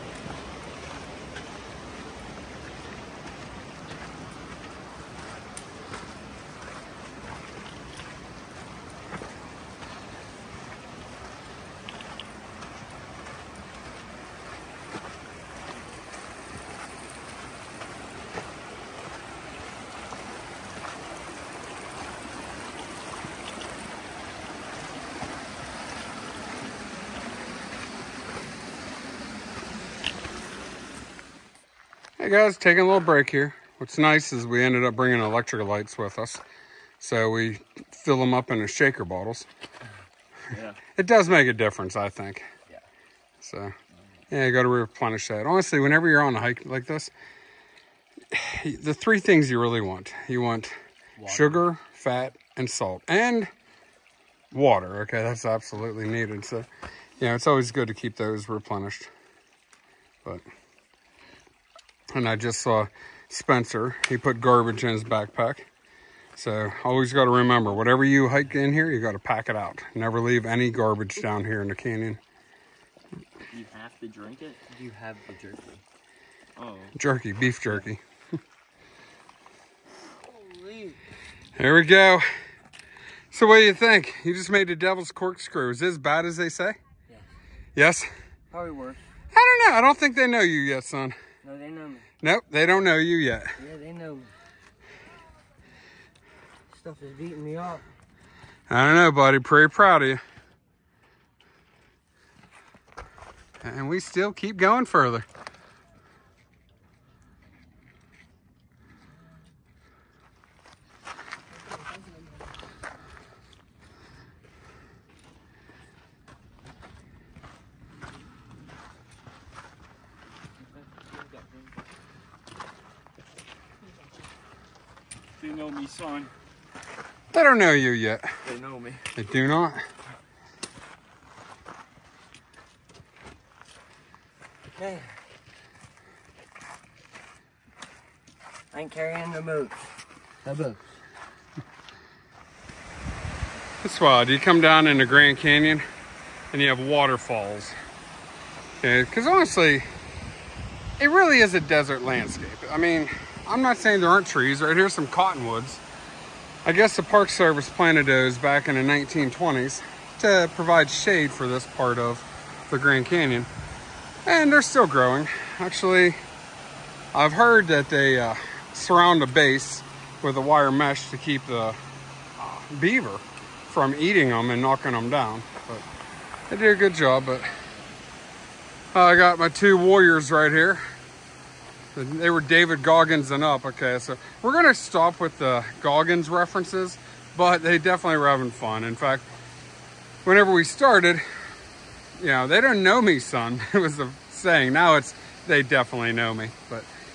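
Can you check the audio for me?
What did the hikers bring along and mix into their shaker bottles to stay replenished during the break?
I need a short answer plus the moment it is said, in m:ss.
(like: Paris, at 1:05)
Electrolytes, at 0:35.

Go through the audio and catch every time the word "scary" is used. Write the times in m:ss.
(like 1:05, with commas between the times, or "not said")
not said.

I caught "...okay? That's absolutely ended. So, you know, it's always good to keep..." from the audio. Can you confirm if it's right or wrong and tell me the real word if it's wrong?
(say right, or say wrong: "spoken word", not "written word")
wrong: "needed", not "ended".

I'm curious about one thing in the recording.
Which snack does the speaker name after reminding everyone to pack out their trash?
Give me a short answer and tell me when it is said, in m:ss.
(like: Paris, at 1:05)
Beef jerky, at 1:16.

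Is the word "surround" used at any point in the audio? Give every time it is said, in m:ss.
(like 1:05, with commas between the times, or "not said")
2:48.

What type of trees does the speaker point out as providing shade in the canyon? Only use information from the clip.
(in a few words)
Cottonwoods.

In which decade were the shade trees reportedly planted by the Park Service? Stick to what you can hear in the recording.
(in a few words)
1920s.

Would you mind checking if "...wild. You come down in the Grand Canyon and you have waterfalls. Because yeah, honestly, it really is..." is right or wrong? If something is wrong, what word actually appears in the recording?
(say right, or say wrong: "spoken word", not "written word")
right.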